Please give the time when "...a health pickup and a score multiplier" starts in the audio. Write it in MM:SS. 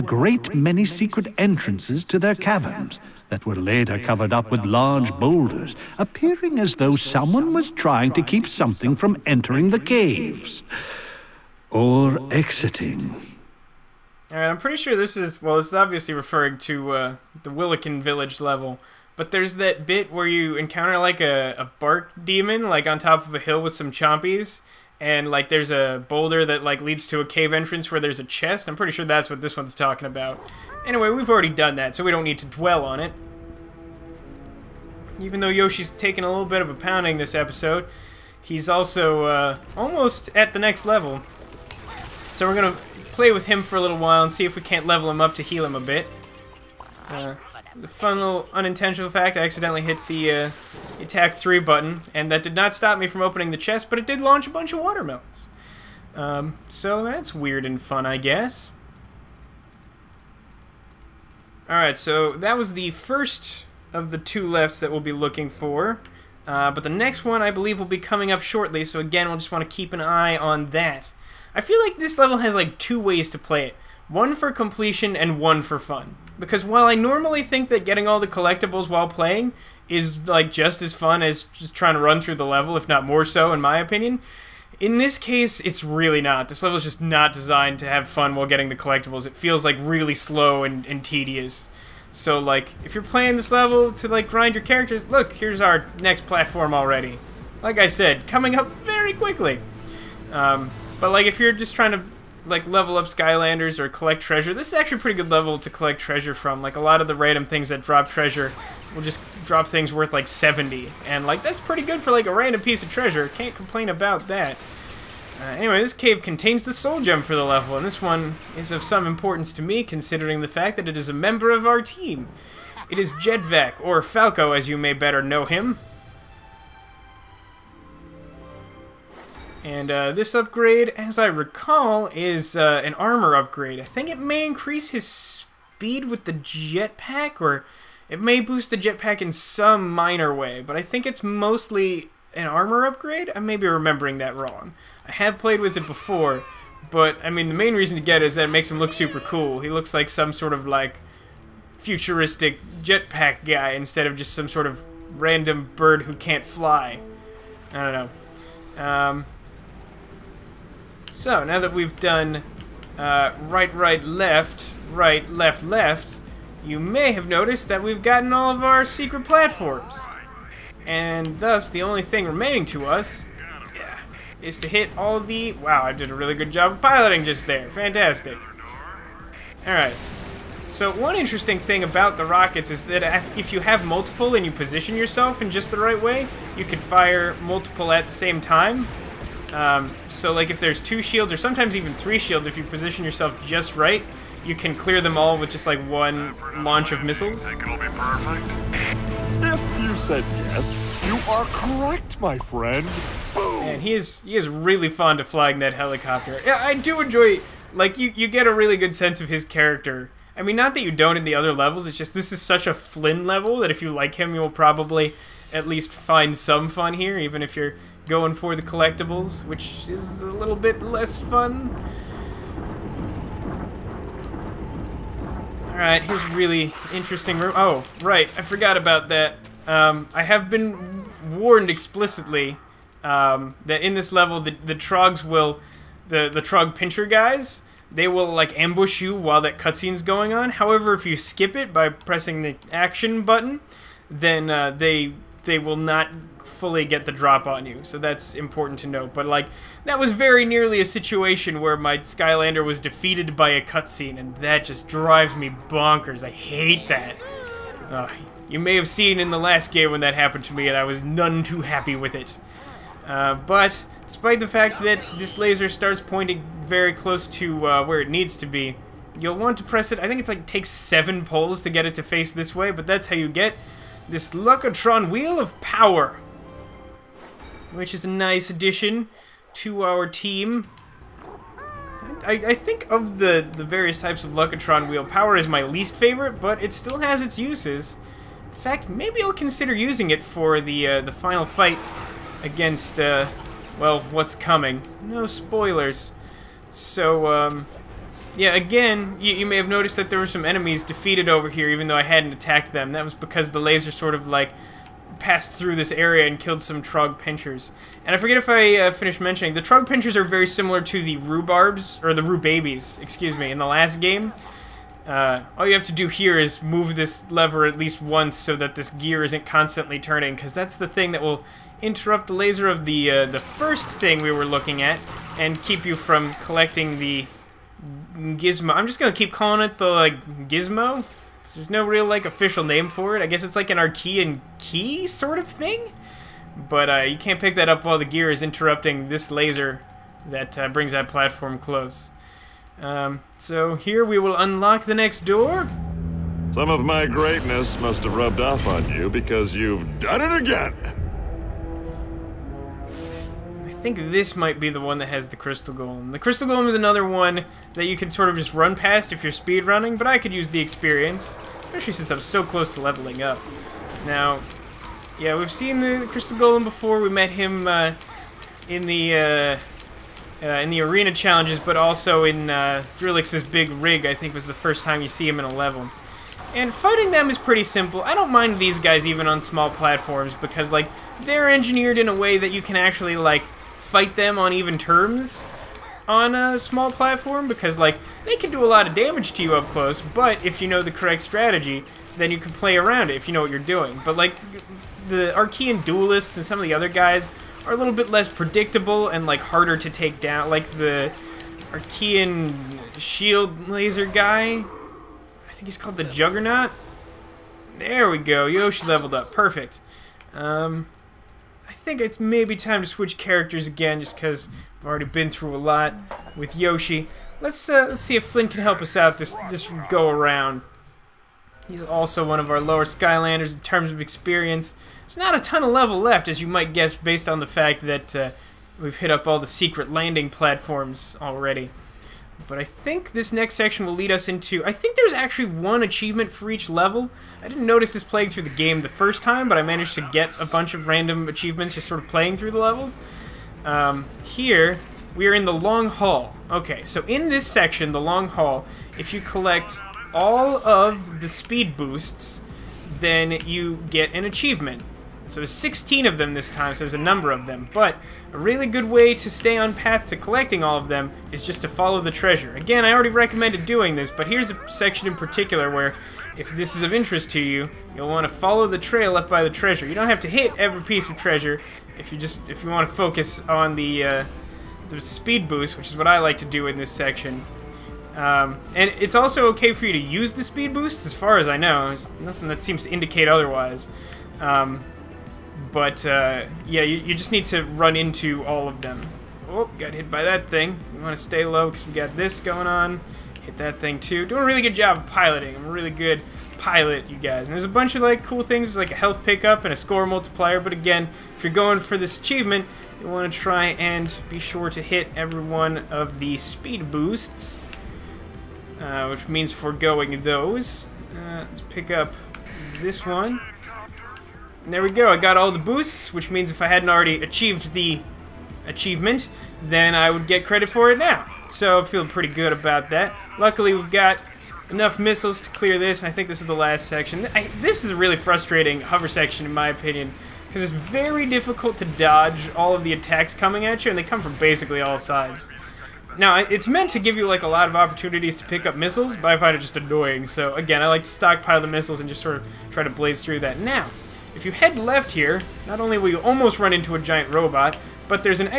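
08:18.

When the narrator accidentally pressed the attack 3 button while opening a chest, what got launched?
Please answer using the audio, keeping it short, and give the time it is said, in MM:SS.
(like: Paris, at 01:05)
watermelons, at 00:54.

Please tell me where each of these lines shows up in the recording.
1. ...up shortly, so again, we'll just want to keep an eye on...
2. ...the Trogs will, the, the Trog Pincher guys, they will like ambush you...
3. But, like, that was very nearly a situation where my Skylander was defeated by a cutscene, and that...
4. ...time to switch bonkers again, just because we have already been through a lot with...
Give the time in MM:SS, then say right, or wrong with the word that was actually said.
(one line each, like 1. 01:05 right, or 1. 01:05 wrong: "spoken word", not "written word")
1. 01:08 right
2. 03:54 right
3. 04:09 right
4. 06:52 wrong: "characters", not "bonkers".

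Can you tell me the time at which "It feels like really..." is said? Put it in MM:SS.
01:29.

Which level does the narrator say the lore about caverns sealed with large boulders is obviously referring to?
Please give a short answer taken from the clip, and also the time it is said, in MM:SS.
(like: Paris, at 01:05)
Wilikin Village, at 00:17.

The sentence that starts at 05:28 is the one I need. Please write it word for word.
I'm just going to keep calling it the, like, gizmo?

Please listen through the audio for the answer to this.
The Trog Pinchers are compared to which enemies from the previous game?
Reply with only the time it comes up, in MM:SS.
05:12.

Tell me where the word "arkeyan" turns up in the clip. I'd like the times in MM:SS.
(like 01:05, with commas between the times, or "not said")
05:33, 06:35, 06:41.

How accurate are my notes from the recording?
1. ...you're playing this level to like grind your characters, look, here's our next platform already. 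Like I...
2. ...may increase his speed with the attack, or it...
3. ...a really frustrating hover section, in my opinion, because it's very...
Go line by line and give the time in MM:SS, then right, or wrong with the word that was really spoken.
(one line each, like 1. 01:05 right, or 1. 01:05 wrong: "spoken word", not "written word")
1. 01:32 right
2. 02:14 wrong: "jetpack", not "attack"
3. 08:47 right.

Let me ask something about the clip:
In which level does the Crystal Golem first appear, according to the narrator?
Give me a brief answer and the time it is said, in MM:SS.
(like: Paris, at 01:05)
Drill-X's big rig, at 06:12.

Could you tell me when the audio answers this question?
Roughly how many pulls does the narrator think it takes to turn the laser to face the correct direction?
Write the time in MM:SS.
04:30.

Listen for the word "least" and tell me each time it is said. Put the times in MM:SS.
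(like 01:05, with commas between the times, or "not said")
03:35, 04:45, 05:17.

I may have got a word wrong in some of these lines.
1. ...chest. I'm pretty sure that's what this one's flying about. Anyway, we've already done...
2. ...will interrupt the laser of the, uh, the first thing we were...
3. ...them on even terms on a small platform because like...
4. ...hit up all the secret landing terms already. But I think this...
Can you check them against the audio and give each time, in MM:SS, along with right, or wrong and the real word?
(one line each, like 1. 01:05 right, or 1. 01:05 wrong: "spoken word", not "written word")
1. 00:28 wrong: "talking", not "flying"
2. 05:21 right
3. 06:24 right
4. 07:08 wrong: "platforms", not "terms".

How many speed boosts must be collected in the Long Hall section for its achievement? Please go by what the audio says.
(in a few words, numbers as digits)
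16.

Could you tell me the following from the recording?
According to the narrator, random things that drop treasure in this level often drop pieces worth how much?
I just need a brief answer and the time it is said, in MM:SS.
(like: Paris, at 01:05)
70, at 01:50.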